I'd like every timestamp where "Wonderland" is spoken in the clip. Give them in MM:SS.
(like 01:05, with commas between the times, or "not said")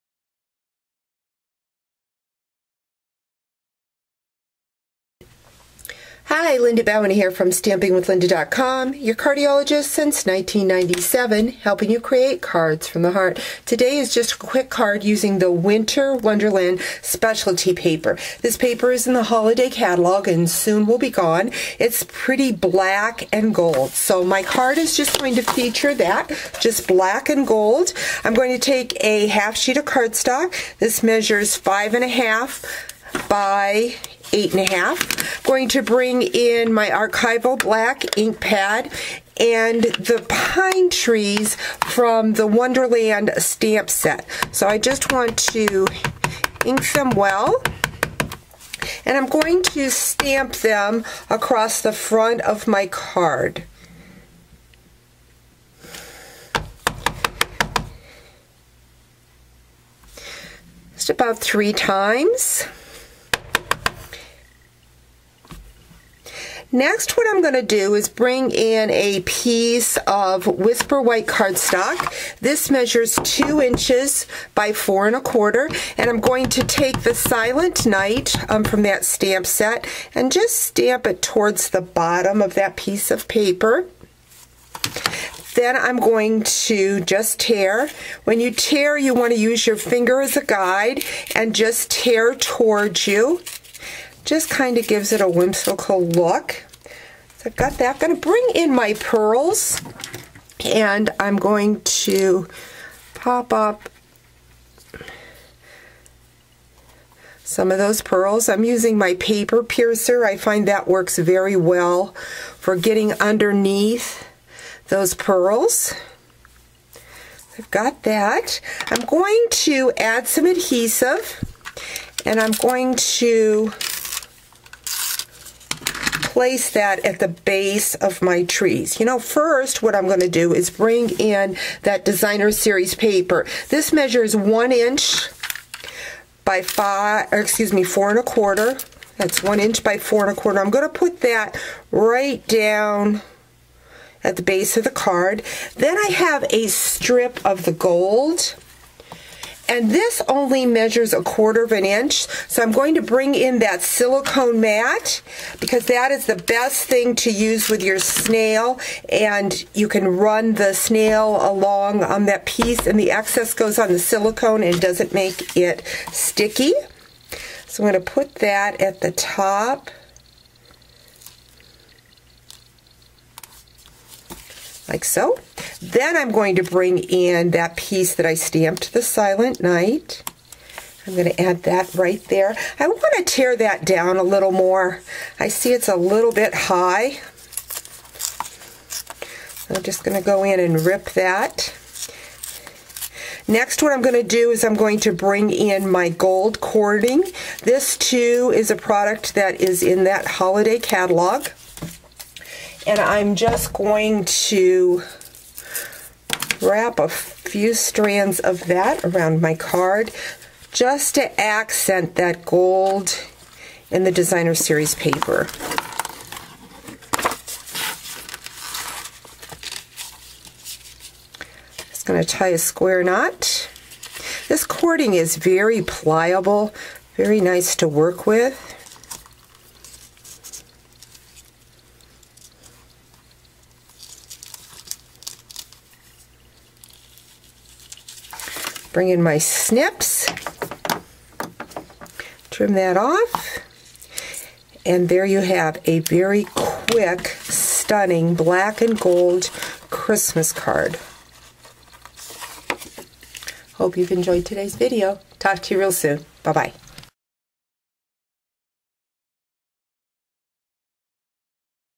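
00:16, 00:42.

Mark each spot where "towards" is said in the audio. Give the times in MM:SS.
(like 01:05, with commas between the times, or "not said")
01:21, 01:32.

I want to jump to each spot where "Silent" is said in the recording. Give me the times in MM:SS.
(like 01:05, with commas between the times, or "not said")
01:17, 02:59.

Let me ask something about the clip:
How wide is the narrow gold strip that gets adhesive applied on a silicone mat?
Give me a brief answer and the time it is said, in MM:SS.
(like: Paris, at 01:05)
a quarter of an inch, at 02:31.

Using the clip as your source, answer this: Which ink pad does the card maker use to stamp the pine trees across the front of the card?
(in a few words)
archival black ink pad.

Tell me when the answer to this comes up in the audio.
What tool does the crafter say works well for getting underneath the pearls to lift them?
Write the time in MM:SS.
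01:49.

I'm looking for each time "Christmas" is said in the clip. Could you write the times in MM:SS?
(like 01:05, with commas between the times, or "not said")
04:09.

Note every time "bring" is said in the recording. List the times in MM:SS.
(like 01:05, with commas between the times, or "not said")
00:35, 01:08, 01:38, 02:10, 02:33, 02:56, 03:15, 03:58.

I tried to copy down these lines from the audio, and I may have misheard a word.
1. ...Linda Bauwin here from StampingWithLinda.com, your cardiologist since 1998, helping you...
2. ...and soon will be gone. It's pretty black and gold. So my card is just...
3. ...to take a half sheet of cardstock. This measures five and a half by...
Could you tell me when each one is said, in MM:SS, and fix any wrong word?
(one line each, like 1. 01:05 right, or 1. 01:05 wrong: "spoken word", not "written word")
1. 00:06 wrong: "1997", not "1998"
2. 00:20 right
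3. 00:28 right.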